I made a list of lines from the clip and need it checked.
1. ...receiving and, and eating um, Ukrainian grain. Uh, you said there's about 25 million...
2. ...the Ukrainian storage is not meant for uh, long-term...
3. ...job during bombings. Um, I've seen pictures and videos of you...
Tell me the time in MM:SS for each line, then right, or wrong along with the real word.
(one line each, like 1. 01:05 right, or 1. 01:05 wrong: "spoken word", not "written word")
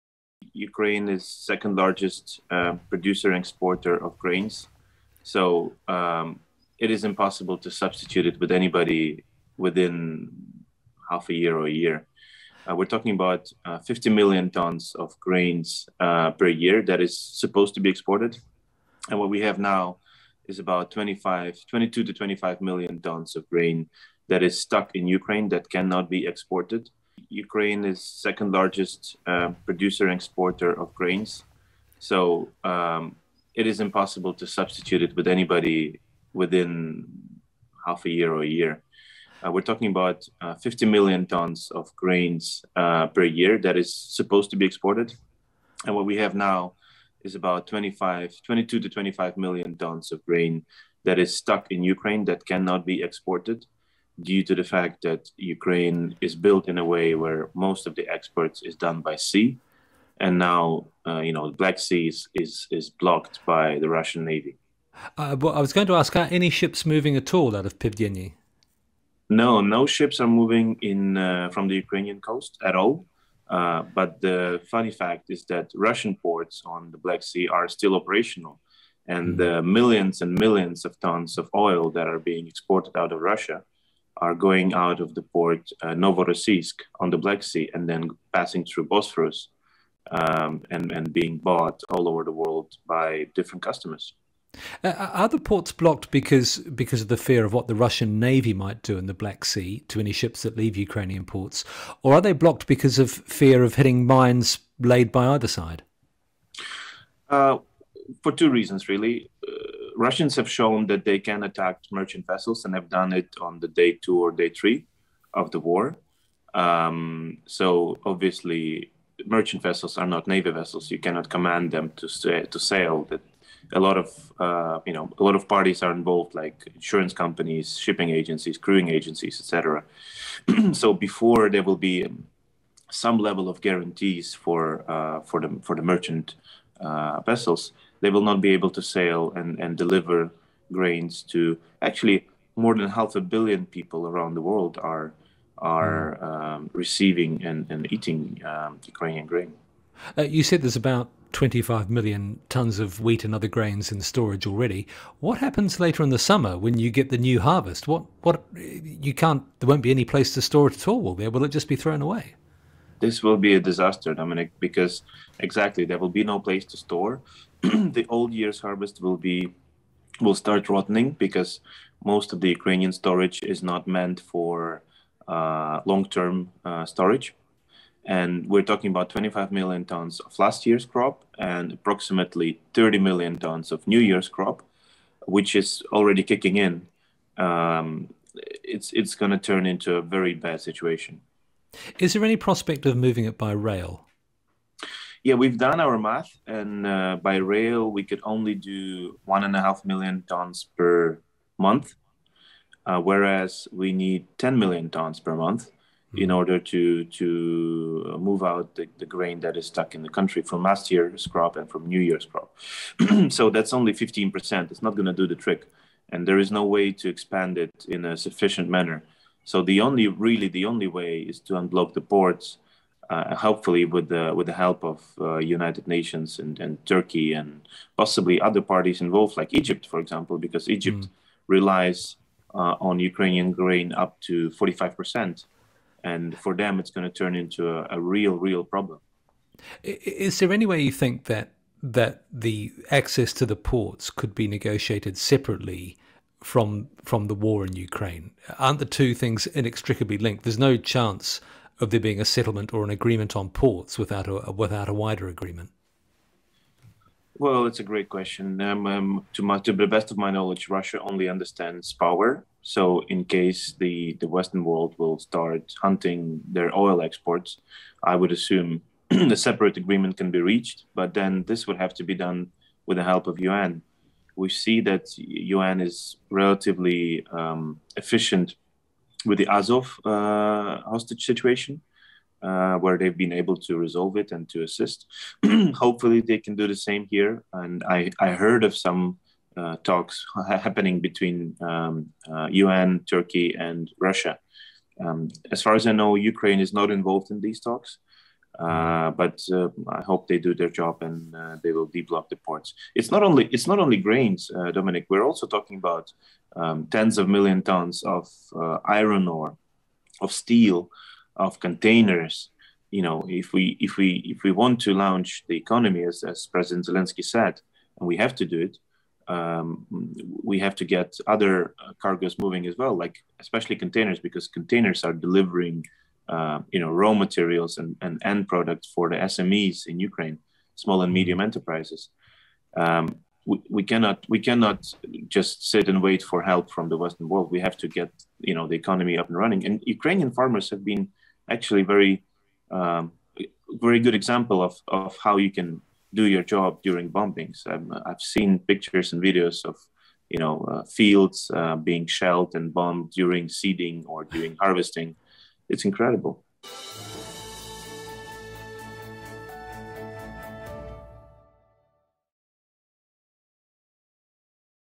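1. 02:26 right
2. 02:52 right
3. 05:46 right.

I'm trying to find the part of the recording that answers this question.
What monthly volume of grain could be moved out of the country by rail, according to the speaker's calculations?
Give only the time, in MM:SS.
03:19.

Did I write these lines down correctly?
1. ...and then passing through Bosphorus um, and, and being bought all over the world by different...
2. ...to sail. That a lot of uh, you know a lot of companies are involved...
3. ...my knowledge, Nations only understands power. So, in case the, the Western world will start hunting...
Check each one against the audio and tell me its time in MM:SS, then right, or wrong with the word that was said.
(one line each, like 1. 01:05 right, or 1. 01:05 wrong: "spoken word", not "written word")
1. 01:27 right
2. 02:02 wrong: "parties", not "companies"
3. 04:20 wrong: "Russia", not "Nations".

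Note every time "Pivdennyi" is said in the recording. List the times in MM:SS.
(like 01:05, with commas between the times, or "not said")
01:07.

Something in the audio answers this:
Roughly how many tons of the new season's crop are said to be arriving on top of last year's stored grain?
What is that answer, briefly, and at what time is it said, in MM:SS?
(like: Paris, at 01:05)
30 million tons, at 03:02.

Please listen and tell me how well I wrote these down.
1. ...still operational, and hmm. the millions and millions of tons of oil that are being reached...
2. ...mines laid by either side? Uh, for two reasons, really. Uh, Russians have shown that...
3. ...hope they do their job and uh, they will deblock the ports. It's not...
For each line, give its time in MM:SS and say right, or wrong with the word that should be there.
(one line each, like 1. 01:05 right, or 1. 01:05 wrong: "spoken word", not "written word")
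1. 01:17 wrong: "exported", not "reached"
2. 01:44 right
3. 05:00 right.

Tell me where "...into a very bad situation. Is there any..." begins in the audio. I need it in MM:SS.
03:09.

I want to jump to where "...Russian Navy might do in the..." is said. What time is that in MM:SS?
01:37.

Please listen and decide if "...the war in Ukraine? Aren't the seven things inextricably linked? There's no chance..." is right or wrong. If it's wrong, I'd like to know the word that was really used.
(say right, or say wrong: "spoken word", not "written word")
wrong: "two", not "seven".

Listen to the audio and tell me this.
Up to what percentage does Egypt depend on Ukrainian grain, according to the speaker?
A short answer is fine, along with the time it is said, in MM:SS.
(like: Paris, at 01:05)
45%, at 03:54.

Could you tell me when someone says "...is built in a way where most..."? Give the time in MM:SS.
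00:56.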